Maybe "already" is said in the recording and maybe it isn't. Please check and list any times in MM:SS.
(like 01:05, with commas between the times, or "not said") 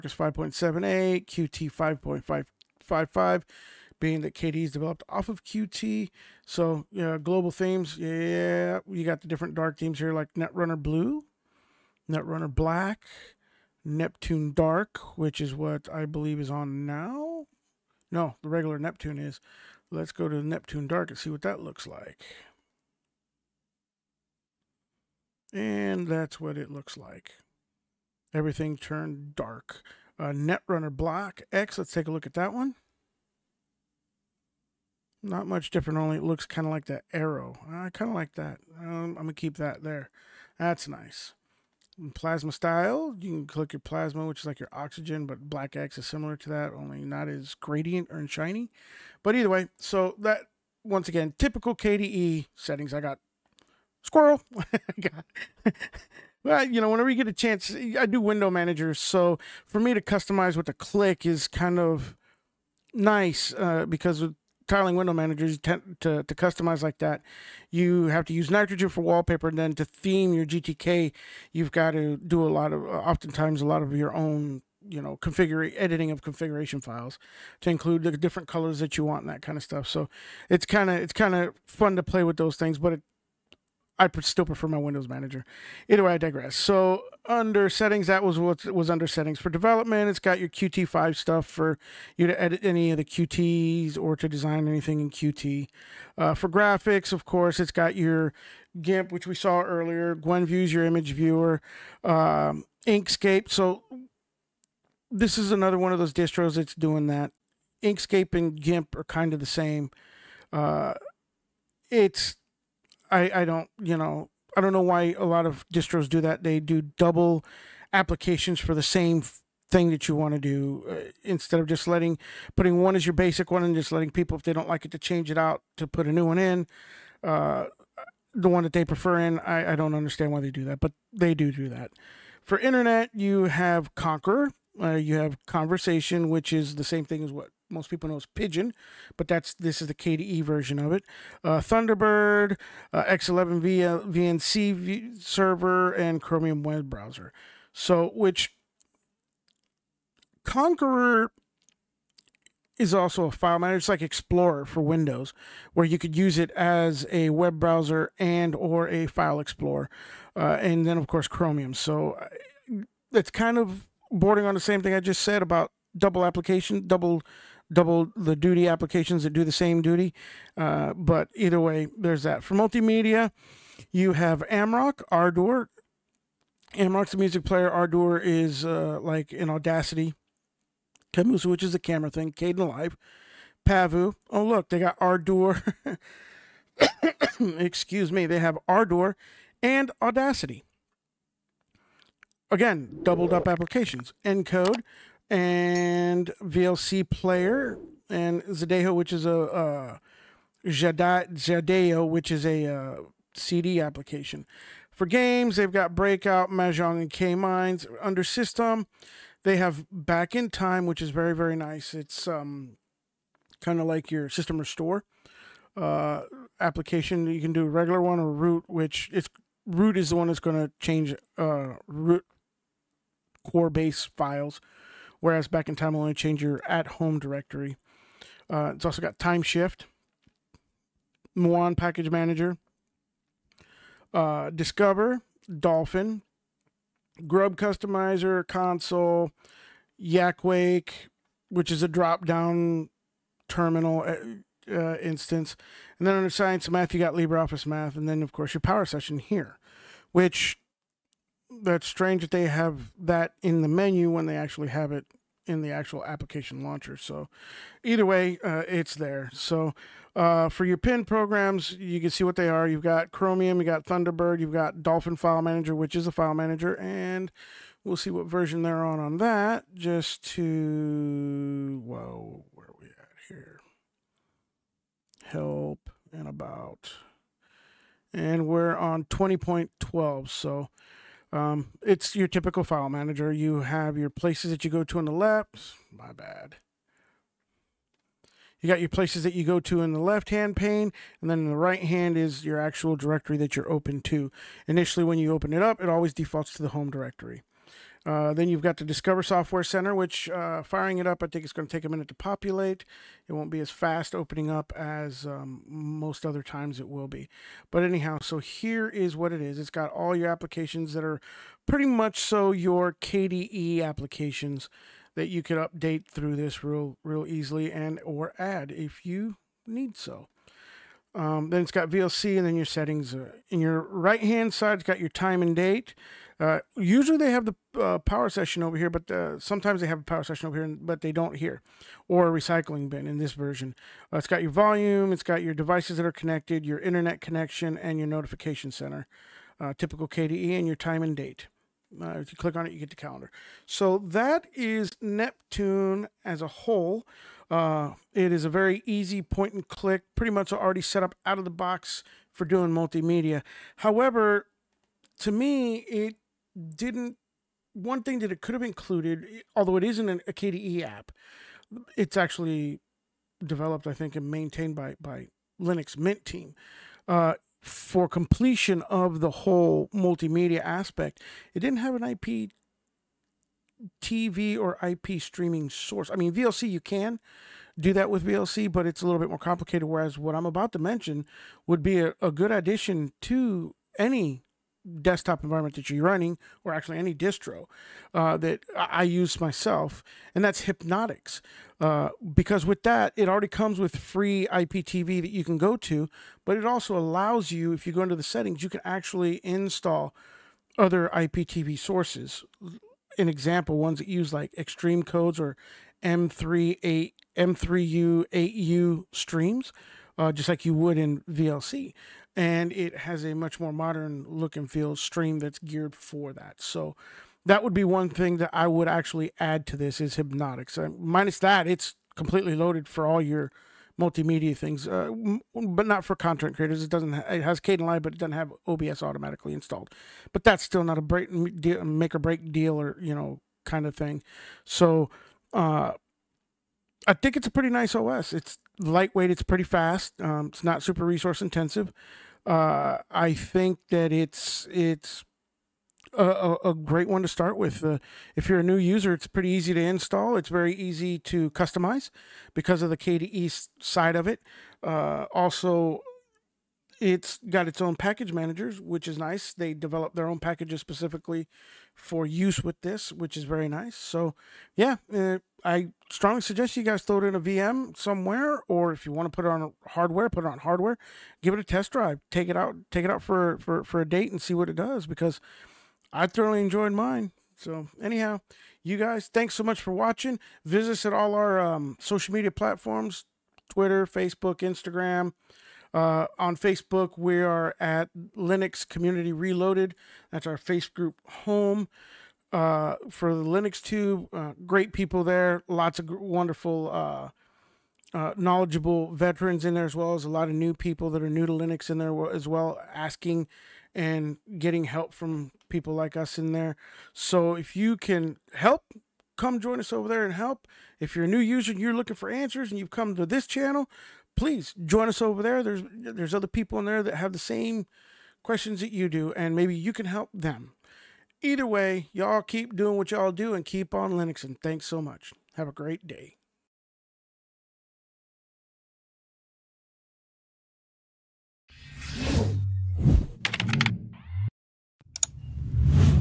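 05:50, 06:33.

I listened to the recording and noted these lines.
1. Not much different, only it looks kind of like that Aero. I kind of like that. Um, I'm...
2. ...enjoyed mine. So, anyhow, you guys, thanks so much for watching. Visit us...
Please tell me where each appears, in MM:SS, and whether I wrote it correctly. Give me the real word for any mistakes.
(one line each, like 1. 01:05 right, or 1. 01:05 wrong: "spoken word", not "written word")
1. 00:35 right
2. 07:56 right.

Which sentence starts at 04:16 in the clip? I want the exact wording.
So either way, uh, it's there.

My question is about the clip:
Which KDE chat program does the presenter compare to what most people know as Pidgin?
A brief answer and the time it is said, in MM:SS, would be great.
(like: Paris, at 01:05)
Konversation, at 02:15.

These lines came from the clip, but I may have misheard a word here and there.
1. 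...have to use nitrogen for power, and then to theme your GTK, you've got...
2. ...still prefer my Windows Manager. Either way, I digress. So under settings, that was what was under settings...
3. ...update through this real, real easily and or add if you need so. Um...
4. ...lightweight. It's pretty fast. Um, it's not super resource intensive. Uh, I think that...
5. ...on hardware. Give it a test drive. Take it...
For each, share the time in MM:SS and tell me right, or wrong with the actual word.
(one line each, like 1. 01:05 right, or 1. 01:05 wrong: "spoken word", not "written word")
1. 01:08 wrong: "wallpaper", not "power"
2. 01:24 right
3. 05:15 right
4. 07:18 right
5. 07:50 right.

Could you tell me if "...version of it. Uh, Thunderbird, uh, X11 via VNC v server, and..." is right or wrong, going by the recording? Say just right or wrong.
right.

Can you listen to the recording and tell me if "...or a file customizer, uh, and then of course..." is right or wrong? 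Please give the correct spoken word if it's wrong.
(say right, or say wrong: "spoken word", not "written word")
wrong: "explorer", not "customizer".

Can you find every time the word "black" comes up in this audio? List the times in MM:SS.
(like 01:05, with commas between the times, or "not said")
00:12, 00:30, 00:45.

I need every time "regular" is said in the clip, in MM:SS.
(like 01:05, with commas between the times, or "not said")
00:18, 03:37.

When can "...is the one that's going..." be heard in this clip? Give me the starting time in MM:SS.
03:39.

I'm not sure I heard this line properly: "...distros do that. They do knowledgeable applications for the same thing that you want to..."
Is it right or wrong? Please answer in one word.
wrong.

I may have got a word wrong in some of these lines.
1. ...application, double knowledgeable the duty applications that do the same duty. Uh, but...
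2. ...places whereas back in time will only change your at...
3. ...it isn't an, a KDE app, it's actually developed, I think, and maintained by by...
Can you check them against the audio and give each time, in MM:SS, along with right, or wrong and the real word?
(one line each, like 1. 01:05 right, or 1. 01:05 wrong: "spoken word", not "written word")
1. 02:46 wrong: "double", not "knowledgeable"
2. 03:44 wrong: "files", not "places"
3. 05:59 right.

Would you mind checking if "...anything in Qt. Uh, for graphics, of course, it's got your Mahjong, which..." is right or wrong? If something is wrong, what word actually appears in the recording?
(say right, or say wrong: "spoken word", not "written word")
wrong: "GIMP", not "Mahjong".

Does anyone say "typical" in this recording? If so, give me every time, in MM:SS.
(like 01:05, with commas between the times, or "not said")
00:51, 04:42, 05:39.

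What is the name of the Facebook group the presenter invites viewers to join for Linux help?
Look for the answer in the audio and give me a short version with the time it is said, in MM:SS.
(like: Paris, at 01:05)
Linux Community Reloaded, at 08:08.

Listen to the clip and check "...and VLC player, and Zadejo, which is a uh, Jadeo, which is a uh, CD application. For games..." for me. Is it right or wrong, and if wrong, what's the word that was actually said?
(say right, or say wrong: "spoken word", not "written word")
right.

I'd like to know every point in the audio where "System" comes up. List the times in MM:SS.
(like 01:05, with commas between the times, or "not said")
03:28, 03:34.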